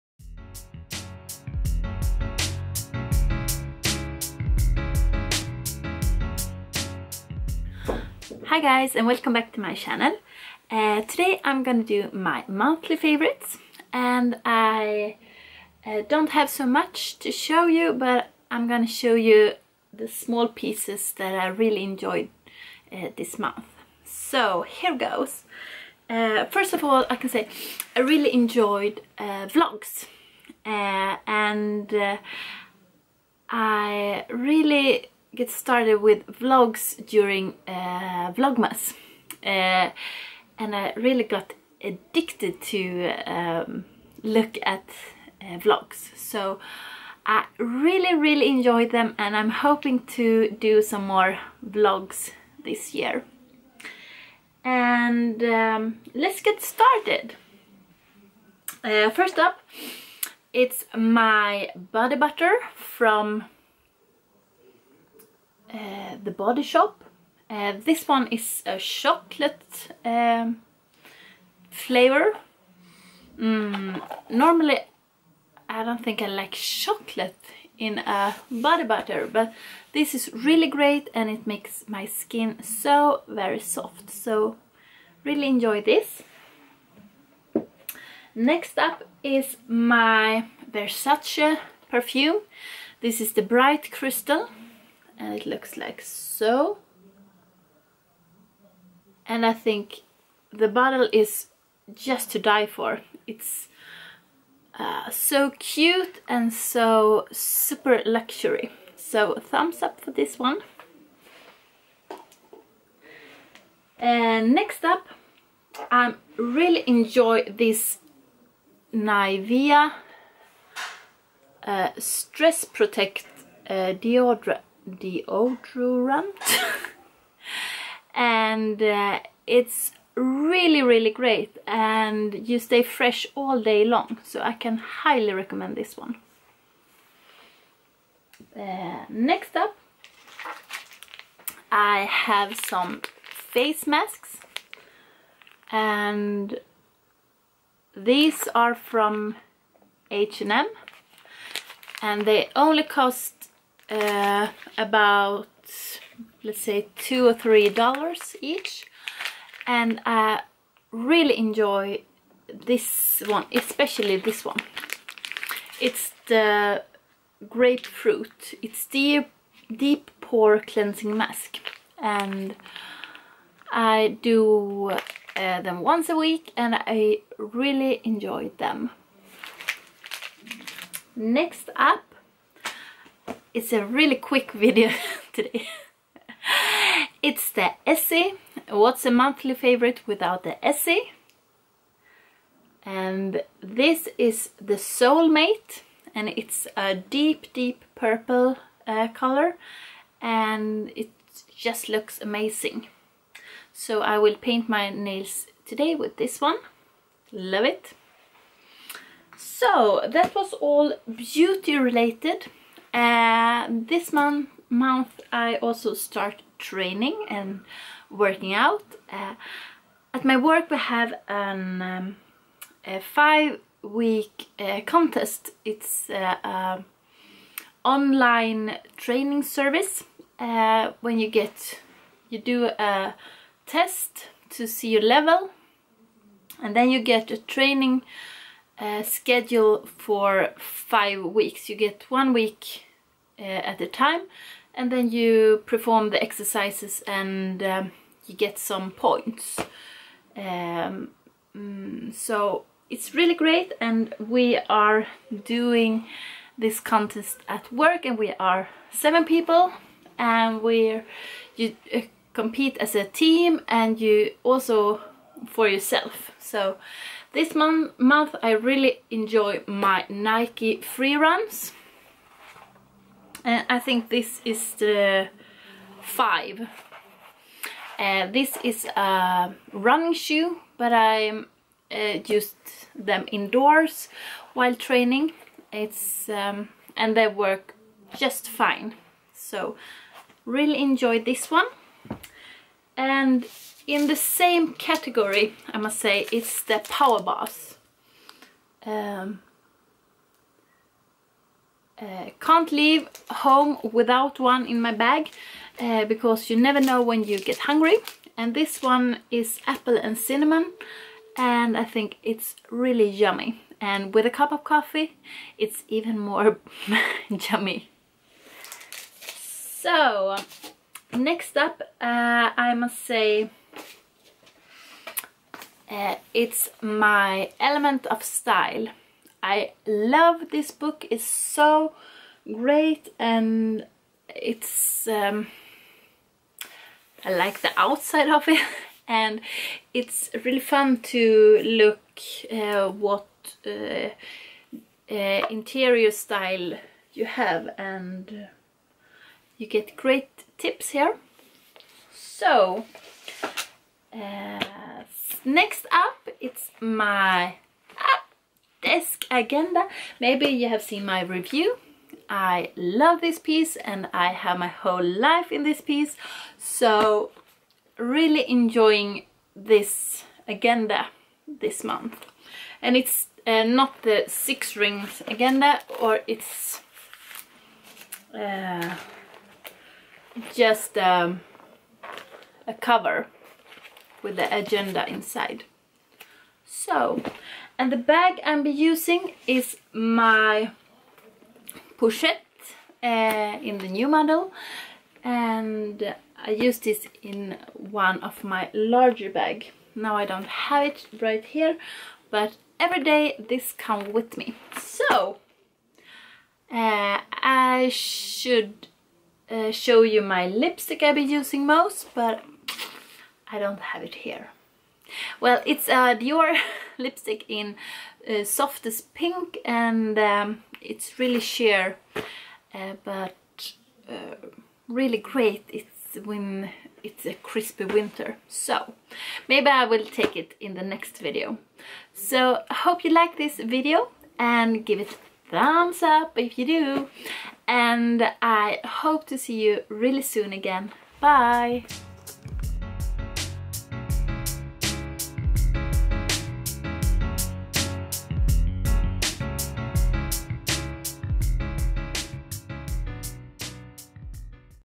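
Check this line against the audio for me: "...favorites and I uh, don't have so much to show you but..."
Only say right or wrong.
right.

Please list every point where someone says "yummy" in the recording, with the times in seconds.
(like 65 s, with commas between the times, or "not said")
313 s, 317 s.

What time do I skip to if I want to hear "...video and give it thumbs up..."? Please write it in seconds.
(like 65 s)
433 s.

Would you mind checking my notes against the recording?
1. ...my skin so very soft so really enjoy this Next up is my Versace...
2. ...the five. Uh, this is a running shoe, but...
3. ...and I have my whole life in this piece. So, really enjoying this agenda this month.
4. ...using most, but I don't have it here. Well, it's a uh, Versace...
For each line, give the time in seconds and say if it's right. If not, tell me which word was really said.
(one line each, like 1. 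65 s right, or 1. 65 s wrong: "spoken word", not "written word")
1. 81 s right
2. 274 s right
3. 363 s right
4. 411 s wrong: "Dior", not "Versace".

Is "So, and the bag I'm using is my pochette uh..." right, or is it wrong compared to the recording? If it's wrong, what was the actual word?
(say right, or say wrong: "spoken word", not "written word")
right.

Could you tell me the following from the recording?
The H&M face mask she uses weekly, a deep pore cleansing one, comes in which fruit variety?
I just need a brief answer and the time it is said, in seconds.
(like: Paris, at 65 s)
Grapefruit, at 167 s.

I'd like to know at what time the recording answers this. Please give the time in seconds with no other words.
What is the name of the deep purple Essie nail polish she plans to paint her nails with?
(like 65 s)
194 s.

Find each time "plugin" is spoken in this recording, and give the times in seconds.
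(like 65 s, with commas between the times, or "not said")
not said.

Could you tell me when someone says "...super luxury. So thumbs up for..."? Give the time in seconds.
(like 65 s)
107 s.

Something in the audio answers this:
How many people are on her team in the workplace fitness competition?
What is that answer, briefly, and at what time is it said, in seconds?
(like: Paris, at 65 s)
7, at 258 s.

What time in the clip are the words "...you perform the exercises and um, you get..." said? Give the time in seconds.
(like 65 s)
245 s.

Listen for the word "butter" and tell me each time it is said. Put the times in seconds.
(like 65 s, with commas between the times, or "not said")
62 s, 78 s.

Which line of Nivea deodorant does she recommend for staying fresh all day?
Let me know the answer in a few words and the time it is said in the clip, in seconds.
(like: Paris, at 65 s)
Stress Protect, at 121 s.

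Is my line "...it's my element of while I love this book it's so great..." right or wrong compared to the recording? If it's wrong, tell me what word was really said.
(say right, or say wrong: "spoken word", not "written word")
wrong: "style", not "while".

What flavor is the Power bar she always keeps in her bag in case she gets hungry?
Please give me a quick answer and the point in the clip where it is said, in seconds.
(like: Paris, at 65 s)
Apple and cinnamon, at 309 s.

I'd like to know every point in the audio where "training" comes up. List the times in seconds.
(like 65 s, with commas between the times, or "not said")
216 s, 228 s, 237 s, 284 s.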